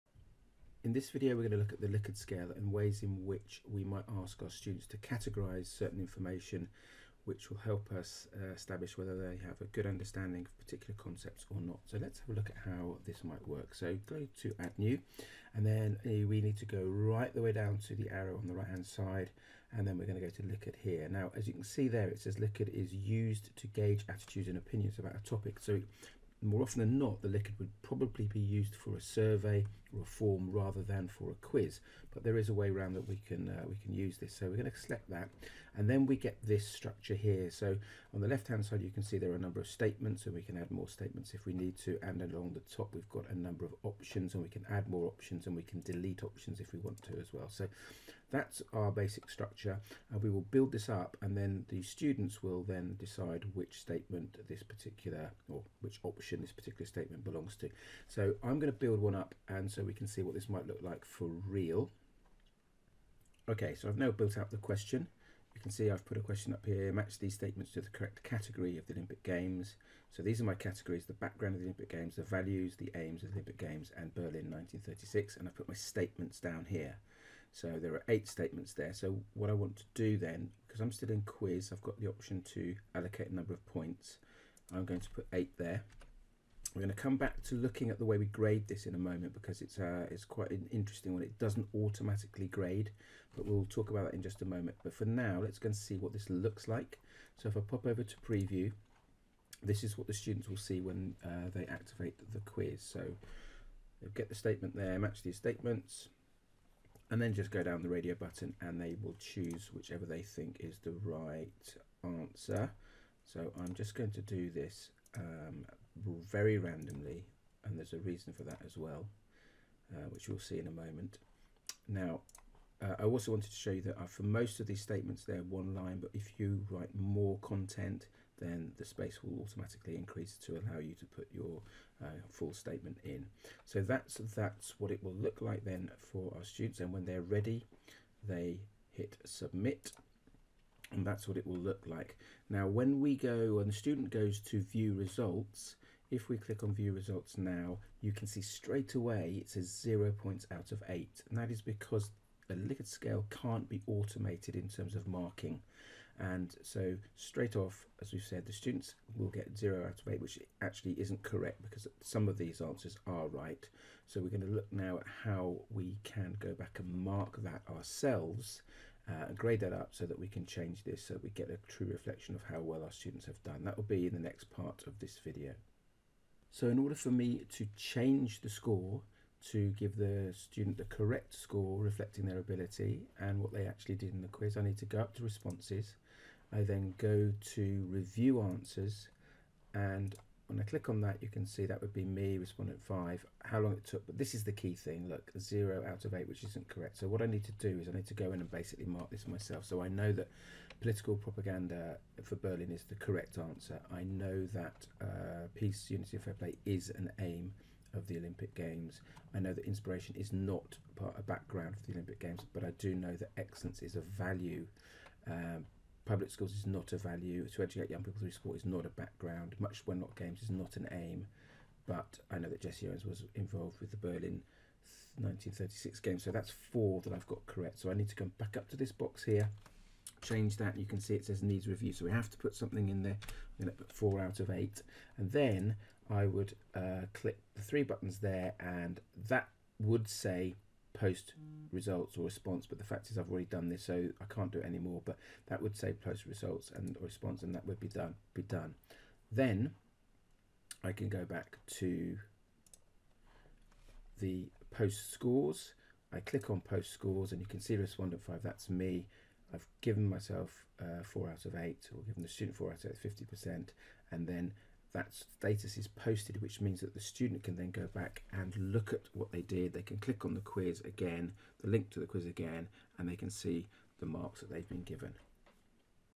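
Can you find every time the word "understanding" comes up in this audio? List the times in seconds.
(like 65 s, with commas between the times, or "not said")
9 s.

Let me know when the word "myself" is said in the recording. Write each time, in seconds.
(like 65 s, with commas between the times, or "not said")
199 s, 260 s.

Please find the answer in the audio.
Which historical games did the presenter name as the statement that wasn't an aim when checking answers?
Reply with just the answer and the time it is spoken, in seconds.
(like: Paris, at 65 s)
Much Wenlock games, at 219 s.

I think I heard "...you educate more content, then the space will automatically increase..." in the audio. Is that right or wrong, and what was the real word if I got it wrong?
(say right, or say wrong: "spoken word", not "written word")
wrong: "write", not "educate".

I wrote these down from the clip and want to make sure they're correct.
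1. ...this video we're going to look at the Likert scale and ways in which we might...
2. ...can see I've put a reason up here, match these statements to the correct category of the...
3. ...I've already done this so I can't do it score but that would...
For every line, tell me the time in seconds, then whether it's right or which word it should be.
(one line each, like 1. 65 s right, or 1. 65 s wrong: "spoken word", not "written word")
1. 0 s right
2. 65 s wrong: "question", not "reason"
3. 243 s wrong: "anymore", not "score".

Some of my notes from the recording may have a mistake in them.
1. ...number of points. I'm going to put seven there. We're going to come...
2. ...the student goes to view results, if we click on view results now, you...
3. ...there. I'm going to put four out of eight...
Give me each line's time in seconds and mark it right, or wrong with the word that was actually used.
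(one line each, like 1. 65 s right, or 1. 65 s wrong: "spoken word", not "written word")
1. 83 s wrong: "eight", not "seven"
2. 143 s right
3. 233 s right.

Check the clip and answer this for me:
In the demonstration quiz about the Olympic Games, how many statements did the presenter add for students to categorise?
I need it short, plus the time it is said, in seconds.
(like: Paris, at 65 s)
8, at 78 s.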